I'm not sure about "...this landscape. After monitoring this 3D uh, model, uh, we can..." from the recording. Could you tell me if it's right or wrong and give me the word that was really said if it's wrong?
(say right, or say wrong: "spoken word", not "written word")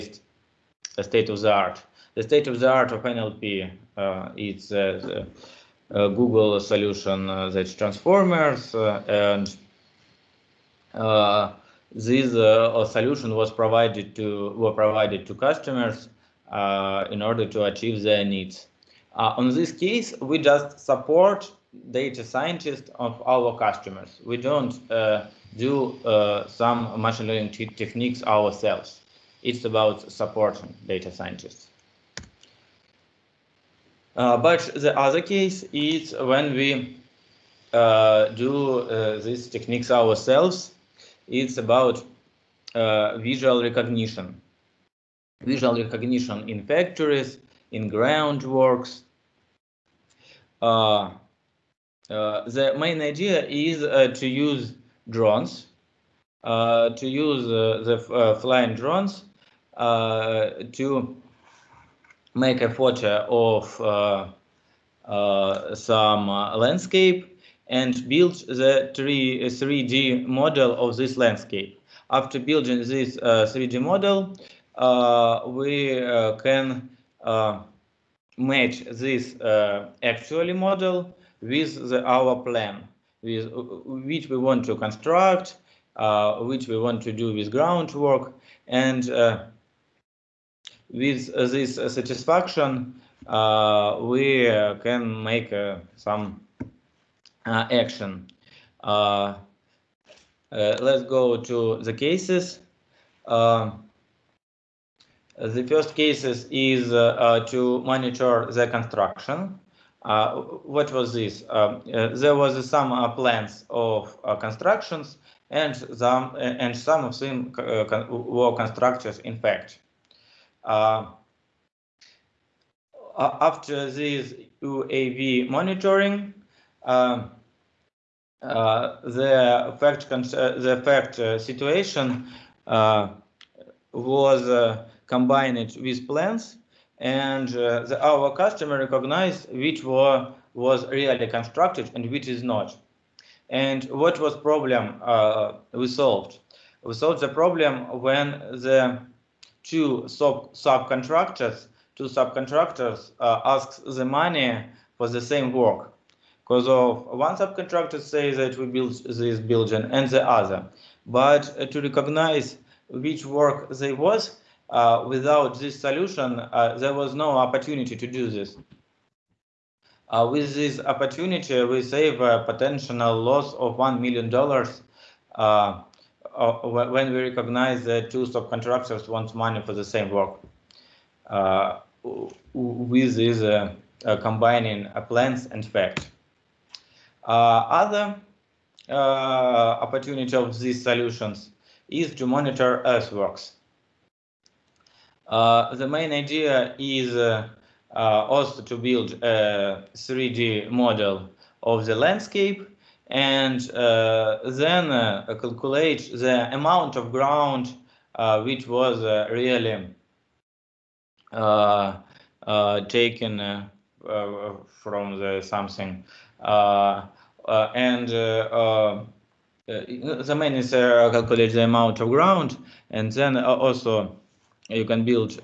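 wrong: "building", not "monitoring".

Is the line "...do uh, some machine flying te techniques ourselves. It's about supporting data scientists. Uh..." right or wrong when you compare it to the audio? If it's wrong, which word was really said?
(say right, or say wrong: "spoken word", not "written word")
wrong: "learning", not "flying".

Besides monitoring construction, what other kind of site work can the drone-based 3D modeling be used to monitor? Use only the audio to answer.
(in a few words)
earthworks.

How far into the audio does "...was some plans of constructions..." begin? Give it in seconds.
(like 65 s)
112 s.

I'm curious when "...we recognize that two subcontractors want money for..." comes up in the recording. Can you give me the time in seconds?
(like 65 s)
177 s.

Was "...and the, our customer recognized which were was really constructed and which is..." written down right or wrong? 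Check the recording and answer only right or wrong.
right.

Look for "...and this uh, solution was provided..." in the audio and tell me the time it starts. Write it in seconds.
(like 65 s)
9 s.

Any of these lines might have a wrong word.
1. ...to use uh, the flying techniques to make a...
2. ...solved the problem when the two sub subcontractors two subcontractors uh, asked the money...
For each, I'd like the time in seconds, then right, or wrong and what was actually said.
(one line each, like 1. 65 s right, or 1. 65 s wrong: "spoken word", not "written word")
1. 56 s wrong: "drones", not "techniques"
2. 146 s right.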